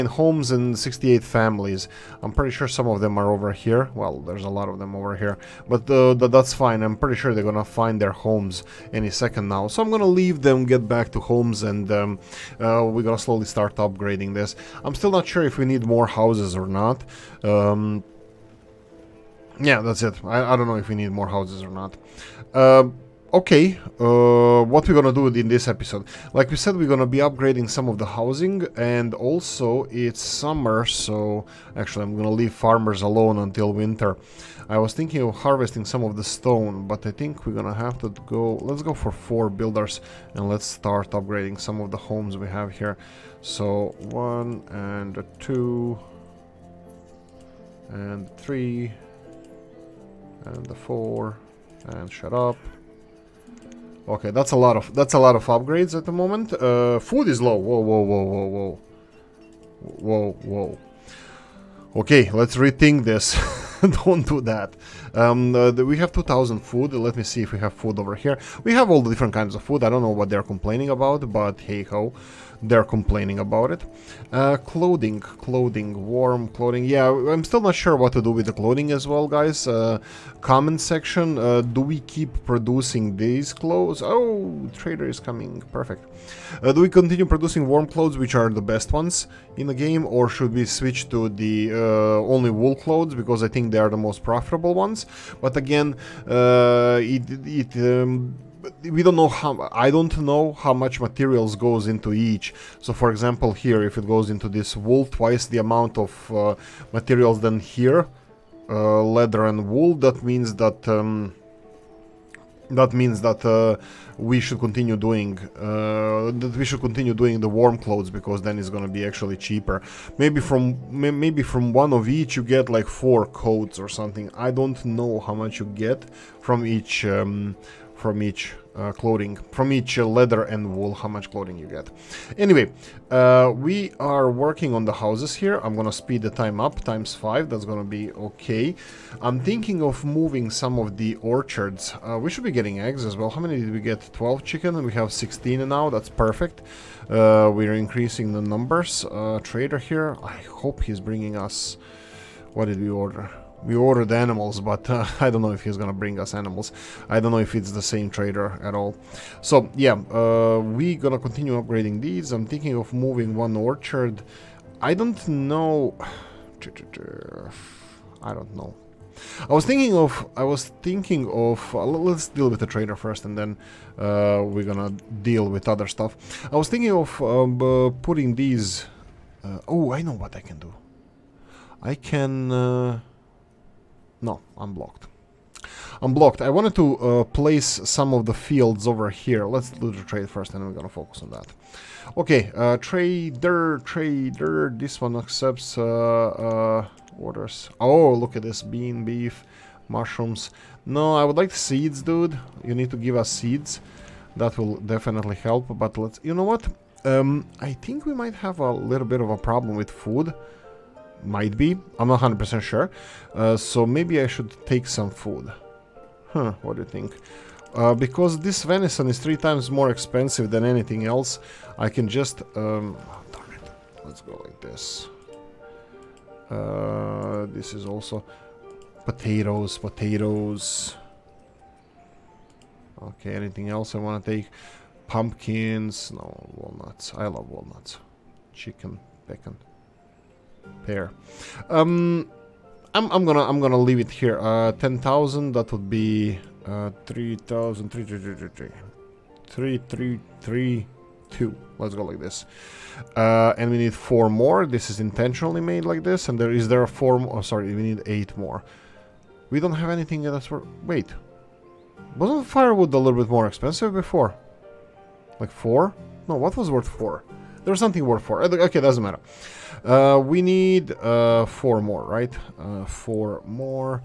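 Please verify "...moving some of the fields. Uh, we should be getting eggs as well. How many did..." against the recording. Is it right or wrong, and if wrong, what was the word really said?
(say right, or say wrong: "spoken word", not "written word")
wrong: "orchards", not "fields".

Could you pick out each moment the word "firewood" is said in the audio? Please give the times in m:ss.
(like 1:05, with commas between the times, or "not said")
4:22.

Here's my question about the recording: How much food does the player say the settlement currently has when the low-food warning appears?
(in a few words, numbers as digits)
2,000.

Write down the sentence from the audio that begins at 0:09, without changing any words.
So I'm gonna leave them, get back to homes, and um, uh, we're gonna slowly start upgrading this.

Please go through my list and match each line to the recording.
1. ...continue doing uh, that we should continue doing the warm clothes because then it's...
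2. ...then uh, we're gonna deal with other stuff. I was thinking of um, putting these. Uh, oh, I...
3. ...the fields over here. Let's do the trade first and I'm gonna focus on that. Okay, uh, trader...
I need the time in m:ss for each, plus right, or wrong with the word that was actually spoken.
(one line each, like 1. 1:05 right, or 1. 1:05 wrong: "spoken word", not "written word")
1. 1:54 right
2. 2:53 right
3. 3:08 right.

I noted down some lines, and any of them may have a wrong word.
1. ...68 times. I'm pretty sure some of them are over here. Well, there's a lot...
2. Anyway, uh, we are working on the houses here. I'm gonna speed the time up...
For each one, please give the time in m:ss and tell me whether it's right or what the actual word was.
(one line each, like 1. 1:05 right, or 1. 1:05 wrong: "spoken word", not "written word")
1. 0:00 wrong: "families", not "times"
2. 2:12 right.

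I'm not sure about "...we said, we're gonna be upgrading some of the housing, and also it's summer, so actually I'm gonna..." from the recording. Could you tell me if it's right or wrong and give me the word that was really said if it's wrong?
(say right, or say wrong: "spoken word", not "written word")
right.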